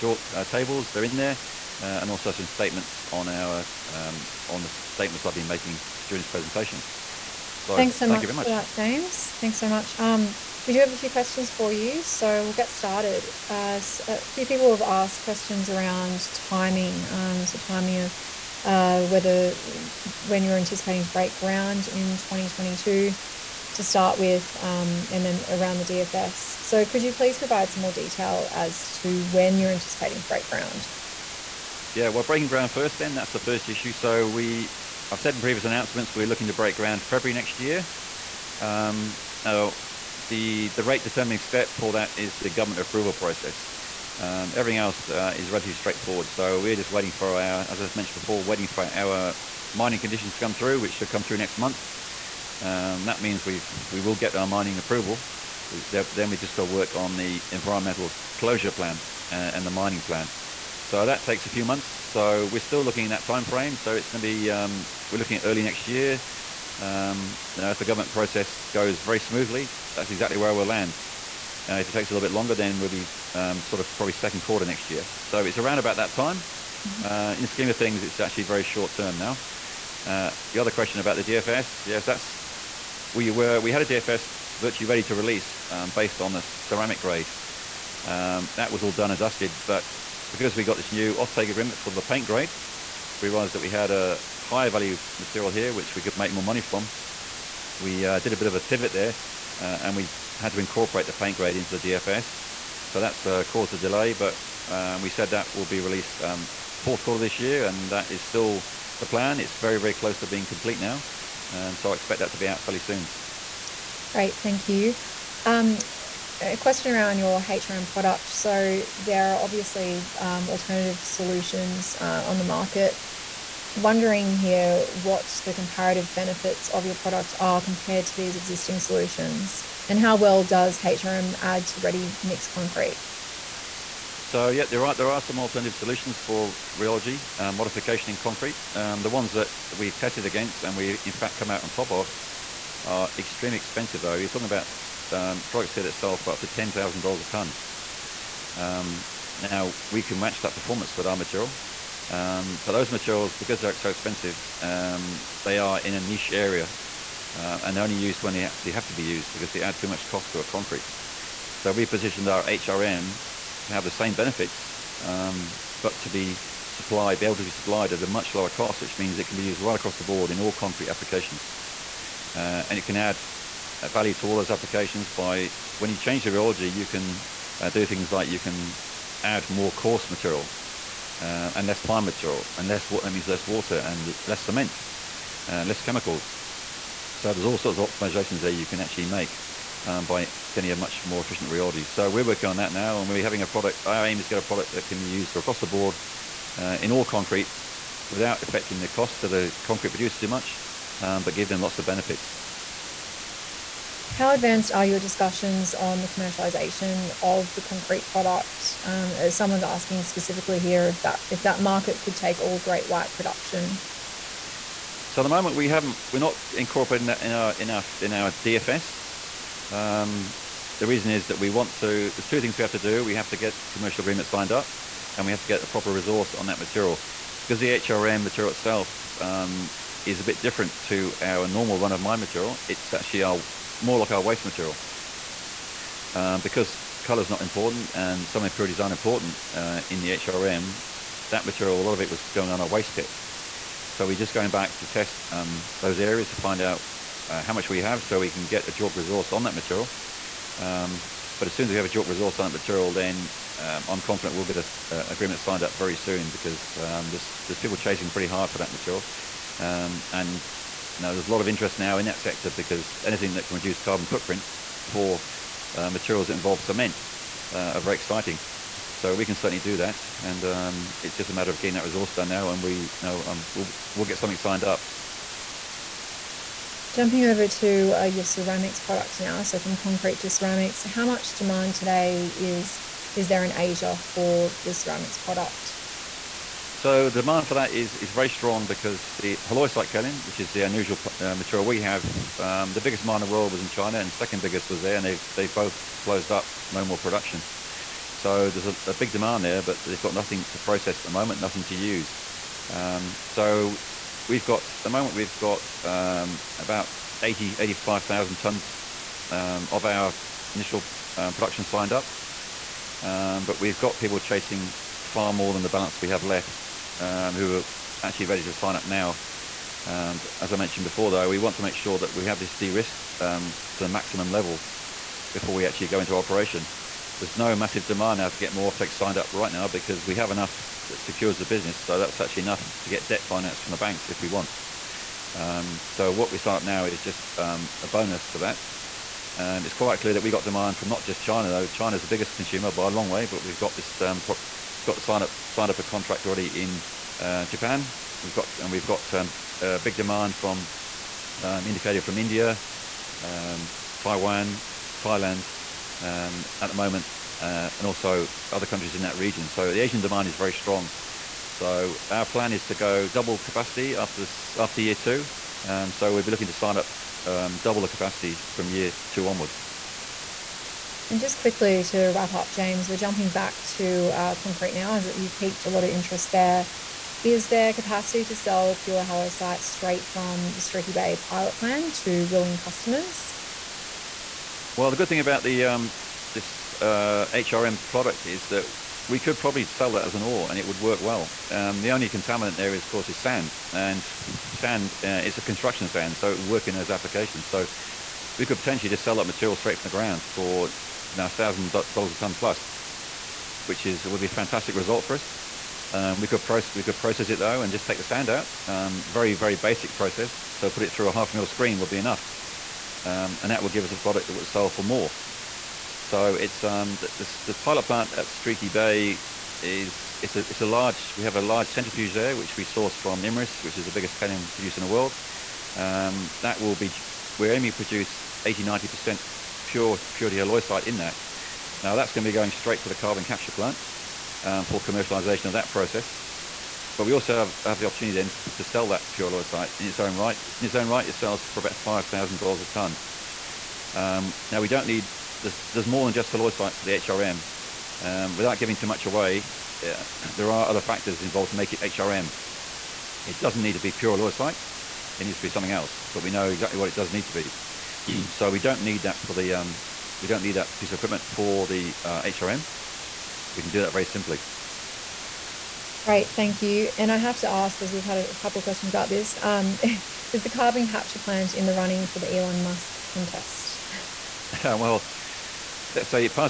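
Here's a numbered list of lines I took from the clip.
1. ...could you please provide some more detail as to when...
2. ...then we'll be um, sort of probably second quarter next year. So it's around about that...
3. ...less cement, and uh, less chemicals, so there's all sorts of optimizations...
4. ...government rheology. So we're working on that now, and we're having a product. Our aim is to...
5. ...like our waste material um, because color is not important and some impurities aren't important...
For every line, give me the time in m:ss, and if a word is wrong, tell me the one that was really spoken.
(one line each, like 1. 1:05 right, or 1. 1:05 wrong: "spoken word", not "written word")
1. 0:26 right
2. 1:12 right
3. 3:04 right
4. 3:11 wrong: "efficient", not "government"
5. 3:53 right.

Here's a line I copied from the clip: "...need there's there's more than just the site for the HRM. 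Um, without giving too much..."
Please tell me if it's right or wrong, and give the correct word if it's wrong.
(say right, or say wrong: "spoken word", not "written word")
right.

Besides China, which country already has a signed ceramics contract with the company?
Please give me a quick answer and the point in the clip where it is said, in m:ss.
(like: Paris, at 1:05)
Japan, at 5:47.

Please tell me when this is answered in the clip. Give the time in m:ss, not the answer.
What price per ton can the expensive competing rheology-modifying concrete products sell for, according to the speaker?
2:26.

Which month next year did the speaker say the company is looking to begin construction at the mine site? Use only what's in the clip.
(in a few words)
February.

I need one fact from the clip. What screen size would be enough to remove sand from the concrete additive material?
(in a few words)
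Half mil.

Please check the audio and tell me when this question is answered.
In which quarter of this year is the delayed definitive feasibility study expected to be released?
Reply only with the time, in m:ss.
1:46.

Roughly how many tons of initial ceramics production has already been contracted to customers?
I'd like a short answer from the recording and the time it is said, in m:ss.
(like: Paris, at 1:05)
80,000 to 85,000 tons, at 5:07.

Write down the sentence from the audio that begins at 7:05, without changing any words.
Um, that will be, we're aiming to produce 80, 90% pure purity site in that.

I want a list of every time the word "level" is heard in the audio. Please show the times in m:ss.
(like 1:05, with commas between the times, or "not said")
5:24.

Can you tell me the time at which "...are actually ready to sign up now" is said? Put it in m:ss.
5:17.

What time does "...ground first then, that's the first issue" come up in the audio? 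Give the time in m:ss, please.
0:32.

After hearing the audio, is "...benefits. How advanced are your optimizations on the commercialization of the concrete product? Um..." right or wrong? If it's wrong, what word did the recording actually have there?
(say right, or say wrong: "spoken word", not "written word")
wrong: "discussions", not "optimizations".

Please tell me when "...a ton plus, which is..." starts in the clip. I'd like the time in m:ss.
6:42.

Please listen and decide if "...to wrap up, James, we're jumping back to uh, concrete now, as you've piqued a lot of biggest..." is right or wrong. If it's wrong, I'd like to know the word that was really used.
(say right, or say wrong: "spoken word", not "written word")
wrong: "interest", not "biggest".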